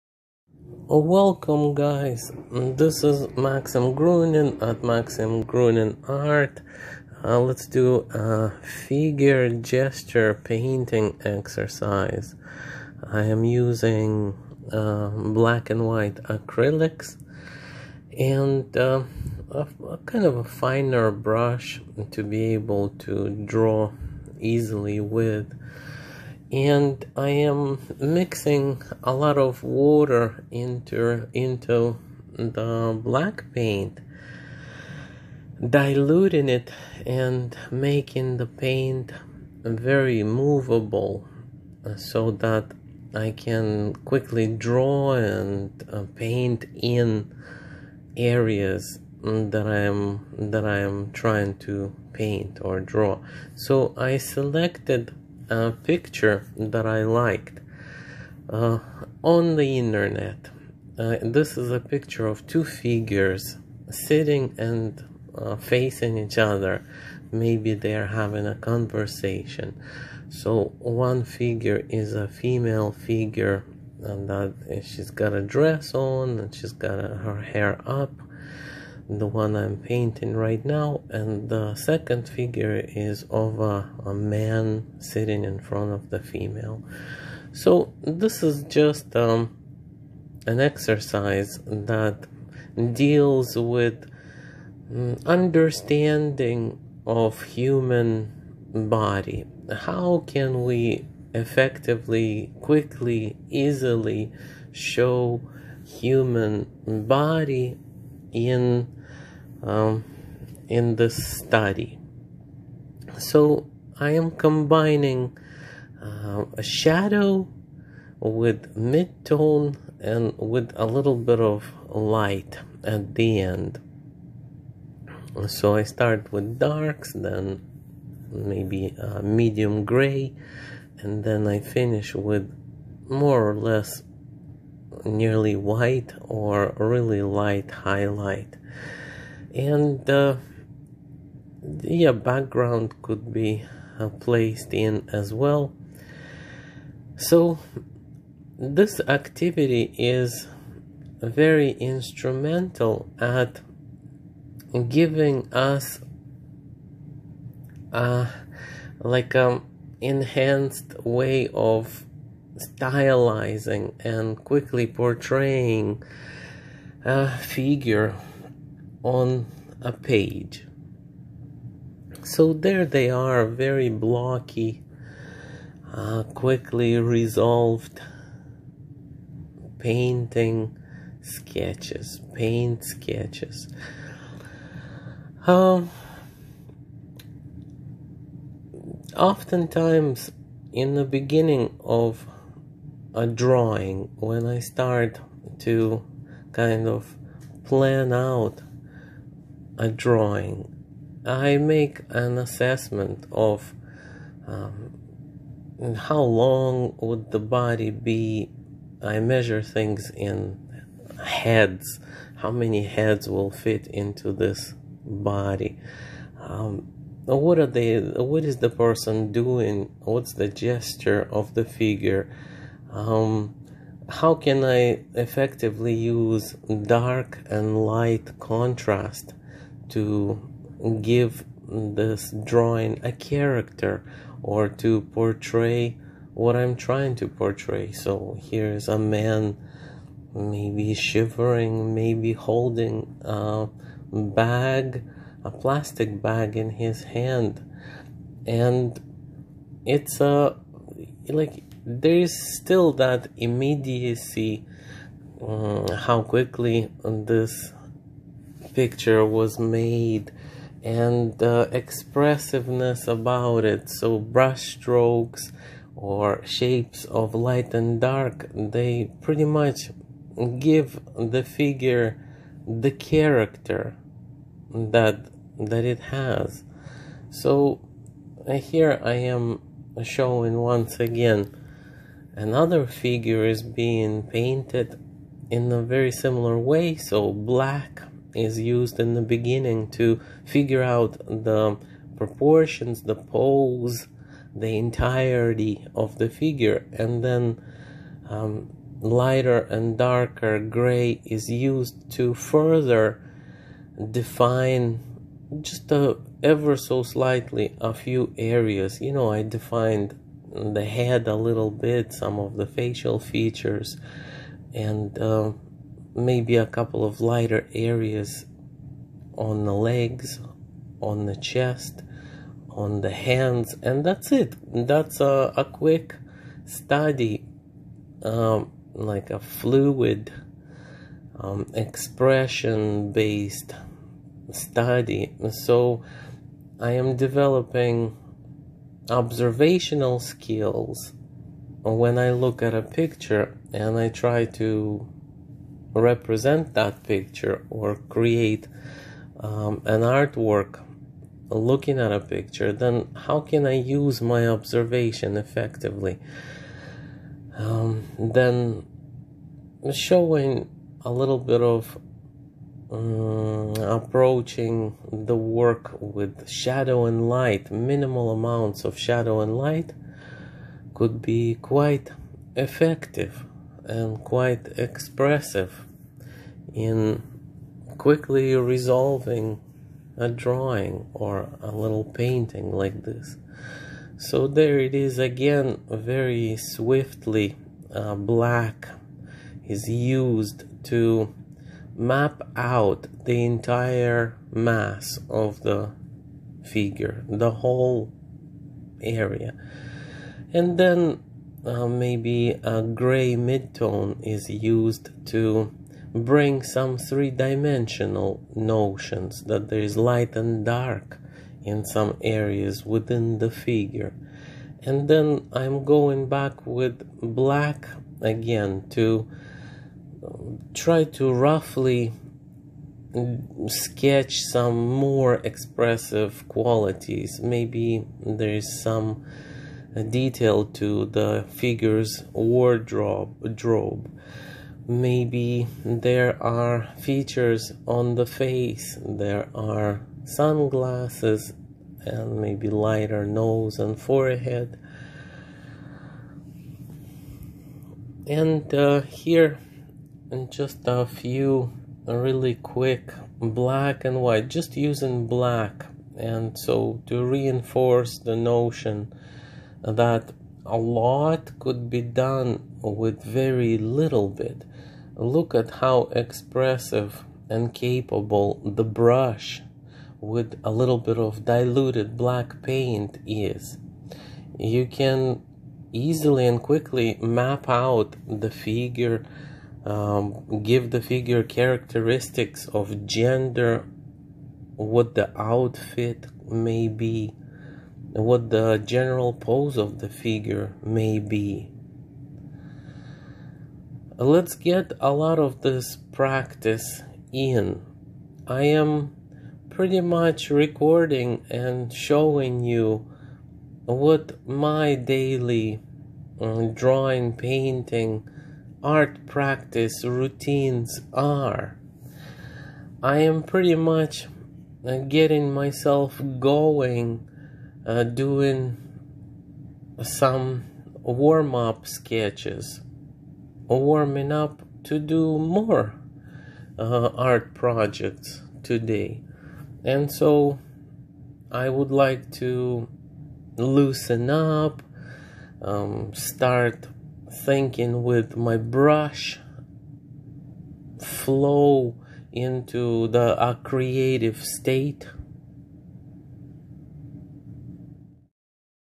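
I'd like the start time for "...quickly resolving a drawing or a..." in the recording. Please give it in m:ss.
6:17.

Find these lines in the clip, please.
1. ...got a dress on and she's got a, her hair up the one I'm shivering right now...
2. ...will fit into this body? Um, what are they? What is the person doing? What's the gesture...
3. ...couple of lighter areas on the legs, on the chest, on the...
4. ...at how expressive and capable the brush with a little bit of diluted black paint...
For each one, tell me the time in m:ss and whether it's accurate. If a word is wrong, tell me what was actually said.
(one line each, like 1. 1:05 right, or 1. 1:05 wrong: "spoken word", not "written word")
1. 1:15 wrong: "painting", not "shivering"
2. 3:33 right
3. 5:16 right
4. 7:45 right.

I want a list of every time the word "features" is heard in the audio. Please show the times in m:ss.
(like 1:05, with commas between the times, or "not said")
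5:13, 7:16.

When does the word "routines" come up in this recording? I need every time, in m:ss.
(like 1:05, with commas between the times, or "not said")
8:30.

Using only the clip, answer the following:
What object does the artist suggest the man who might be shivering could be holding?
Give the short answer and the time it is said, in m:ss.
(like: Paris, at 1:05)
A plastic bag, at 4:05.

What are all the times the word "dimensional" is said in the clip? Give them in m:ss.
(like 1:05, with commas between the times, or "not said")
6:46.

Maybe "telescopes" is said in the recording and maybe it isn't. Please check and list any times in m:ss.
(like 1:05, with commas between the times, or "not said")
not said.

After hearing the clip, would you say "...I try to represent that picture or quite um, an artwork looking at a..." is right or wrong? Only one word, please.
wrong.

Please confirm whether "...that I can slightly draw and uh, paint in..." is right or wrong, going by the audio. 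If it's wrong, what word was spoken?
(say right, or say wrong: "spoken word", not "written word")
wrong: "quickly", not "slightly".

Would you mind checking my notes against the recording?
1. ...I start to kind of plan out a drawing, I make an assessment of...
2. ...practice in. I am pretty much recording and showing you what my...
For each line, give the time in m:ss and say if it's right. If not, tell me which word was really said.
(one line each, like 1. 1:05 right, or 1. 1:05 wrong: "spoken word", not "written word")
1. 3:14 right
2. 8:16 right.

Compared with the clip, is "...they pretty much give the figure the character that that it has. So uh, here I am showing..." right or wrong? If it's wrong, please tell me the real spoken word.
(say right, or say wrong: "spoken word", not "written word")
right.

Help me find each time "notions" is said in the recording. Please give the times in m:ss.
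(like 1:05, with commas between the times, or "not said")
6:48, 7:38.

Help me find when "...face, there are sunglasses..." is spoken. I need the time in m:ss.
7:18.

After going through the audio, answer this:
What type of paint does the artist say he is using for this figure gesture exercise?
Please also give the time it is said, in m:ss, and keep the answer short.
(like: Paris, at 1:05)
Black and white acrylics, at 0:15.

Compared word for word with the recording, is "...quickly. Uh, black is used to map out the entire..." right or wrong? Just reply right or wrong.
wrong.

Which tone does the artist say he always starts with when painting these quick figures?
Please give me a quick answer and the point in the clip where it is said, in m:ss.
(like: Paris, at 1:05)
Darks, at 2:06.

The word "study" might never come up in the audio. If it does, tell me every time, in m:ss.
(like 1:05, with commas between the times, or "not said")
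1:51, 5:26, 5:34.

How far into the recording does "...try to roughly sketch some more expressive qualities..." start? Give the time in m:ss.
7:00.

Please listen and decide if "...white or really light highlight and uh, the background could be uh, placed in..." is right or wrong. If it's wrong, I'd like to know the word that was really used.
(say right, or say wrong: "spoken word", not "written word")
right.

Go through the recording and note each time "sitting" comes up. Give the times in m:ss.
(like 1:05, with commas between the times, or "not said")
1:03, 1:24.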